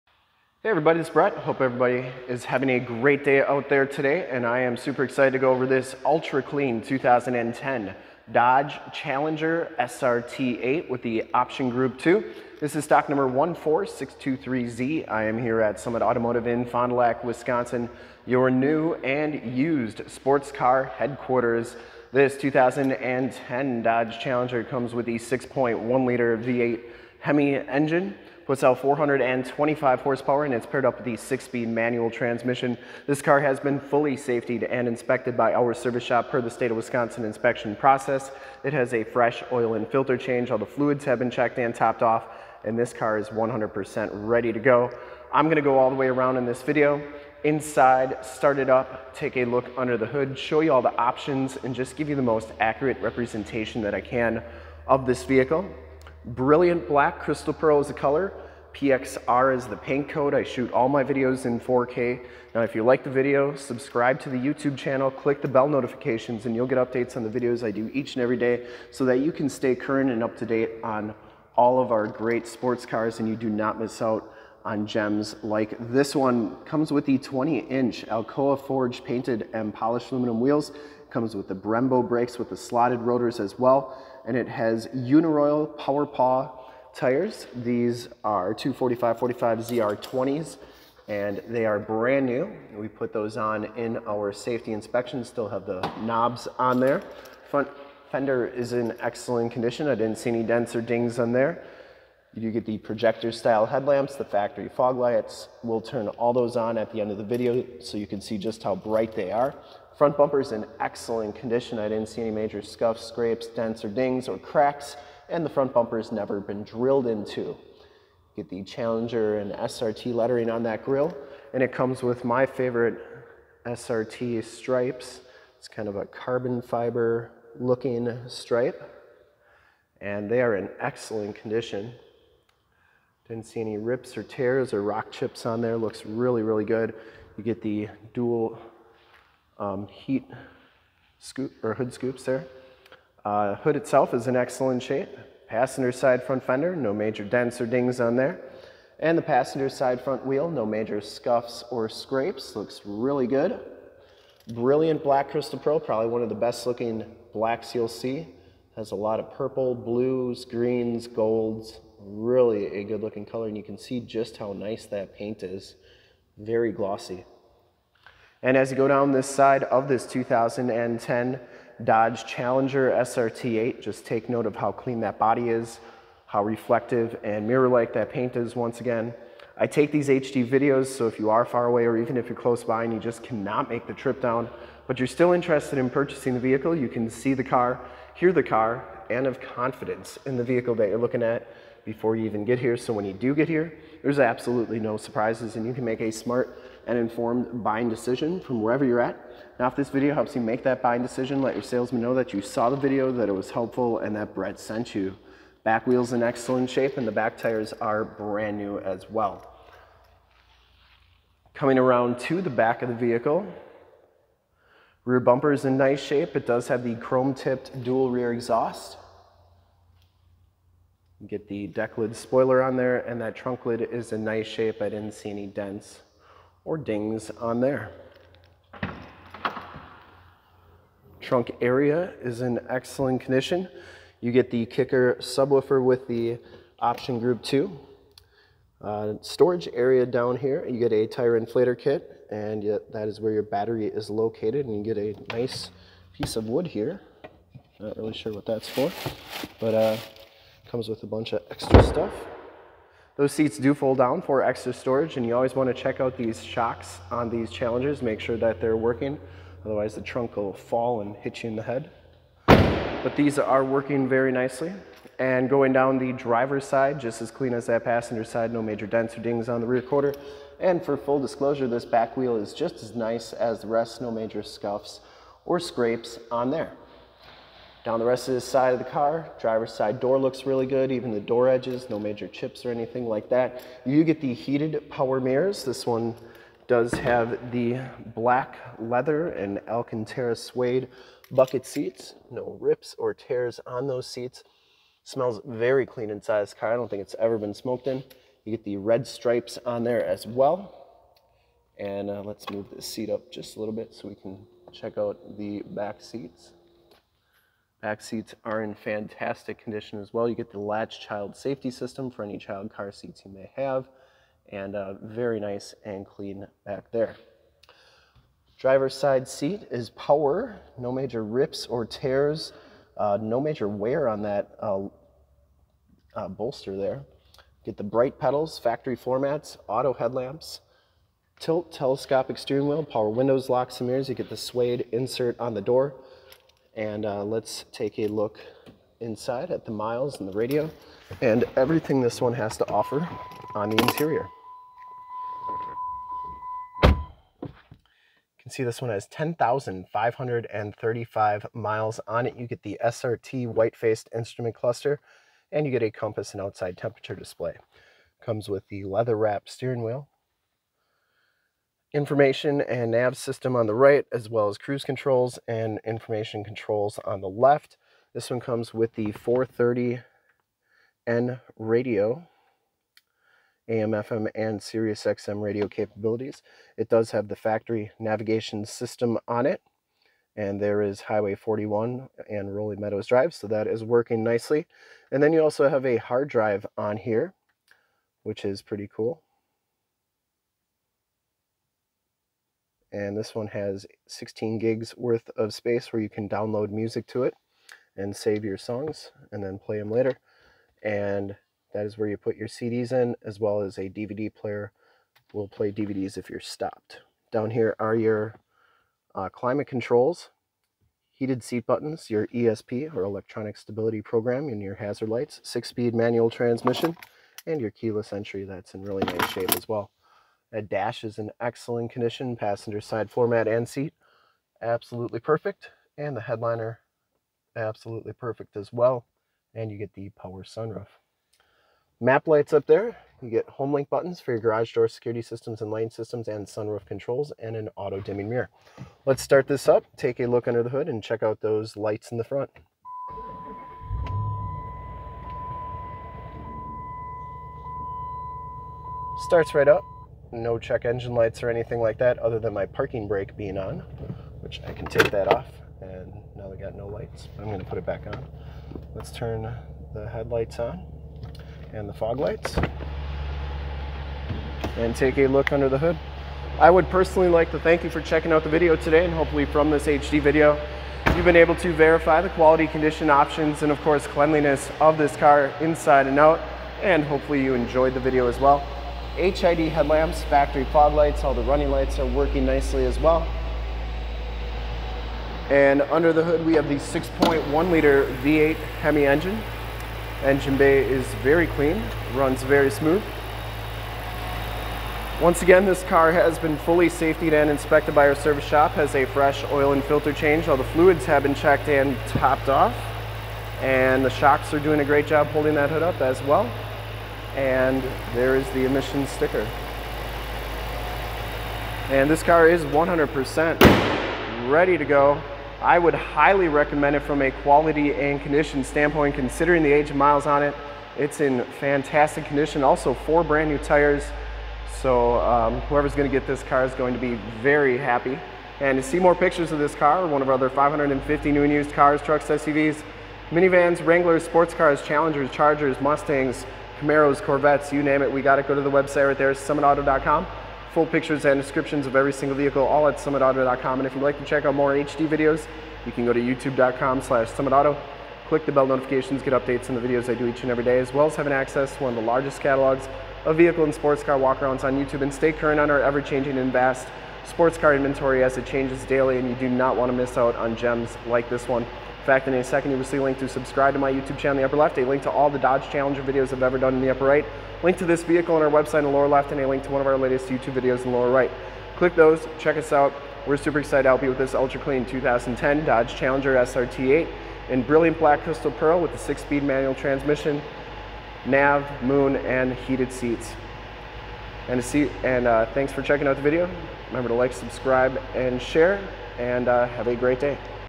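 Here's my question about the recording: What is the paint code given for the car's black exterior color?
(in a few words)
PXR.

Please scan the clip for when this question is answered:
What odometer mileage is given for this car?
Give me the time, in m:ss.
5:49.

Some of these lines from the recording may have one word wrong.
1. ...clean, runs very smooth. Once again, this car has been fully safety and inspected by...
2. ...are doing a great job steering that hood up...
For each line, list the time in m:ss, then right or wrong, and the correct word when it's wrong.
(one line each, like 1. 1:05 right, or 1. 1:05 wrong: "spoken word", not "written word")
1. 8:11 right
2. 8:24 wrong: "holding", not "steering".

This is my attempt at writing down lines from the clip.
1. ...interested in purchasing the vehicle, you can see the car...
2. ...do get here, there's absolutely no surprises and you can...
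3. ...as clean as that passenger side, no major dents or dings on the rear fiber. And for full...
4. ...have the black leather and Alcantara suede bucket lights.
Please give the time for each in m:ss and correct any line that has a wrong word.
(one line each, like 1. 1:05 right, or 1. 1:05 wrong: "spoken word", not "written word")
1. 3:05 right
2. 3:13 right
3. 4:27 wrong: "quarter", not "fiber"
4. 4:46 wrong: "seats", not "lights".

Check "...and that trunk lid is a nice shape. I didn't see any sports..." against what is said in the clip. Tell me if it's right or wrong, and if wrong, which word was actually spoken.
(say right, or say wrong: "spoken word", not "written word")
wrong: "dents", not "sports".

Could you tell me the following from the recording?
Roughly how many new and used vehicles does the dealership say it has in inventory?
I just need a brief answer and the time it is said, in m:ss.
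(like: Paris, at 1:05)
550, at 8:50.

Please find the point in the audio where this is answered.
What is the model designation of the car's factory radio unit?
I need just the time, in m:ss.
6:09.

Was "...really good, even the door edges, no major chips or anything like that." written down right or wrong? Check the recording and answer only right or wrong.
right.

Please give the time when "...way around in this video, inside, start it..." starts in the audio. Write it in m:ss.
0:45.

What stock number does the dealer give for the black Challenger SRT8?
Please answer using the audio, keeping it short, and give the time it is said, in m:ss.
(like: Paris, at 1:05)
14623Z, at 0:13.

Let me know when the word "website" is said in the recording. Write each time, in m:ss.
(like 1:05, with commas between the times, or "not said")
8:58, 9:28.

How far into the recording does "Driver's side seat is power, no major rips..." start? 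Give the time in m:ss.
5:18.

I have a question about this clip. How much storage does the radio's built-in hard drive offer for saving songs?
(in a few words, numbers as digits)
16 gigs.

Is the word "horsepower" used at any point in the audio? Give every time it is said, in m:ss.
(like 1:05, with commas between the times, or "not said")
0:30.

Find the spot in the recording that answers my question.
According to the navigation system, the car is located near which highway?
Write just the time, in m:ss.
6:21.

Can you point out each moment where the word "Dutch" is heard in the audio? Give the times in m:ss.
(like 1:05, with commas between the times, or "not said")
not said.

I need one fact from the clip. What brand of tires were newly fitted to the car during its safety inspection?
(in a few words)
Uniroyal Power Paw.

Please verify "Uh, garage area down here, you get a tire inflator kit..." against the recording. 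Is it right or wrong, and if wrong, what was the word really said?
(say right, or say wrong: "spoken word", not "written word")
wrong: "storage", not "garage".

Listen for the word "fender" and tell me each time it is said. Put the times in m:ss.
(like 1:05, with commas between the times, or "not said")
1:38, 2:26.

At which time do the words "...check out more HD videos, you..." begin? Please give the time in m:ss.
9:04.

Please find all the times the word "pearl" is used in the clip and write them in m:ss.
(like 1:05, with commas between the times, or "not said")
0:57, 2:35, 9:38.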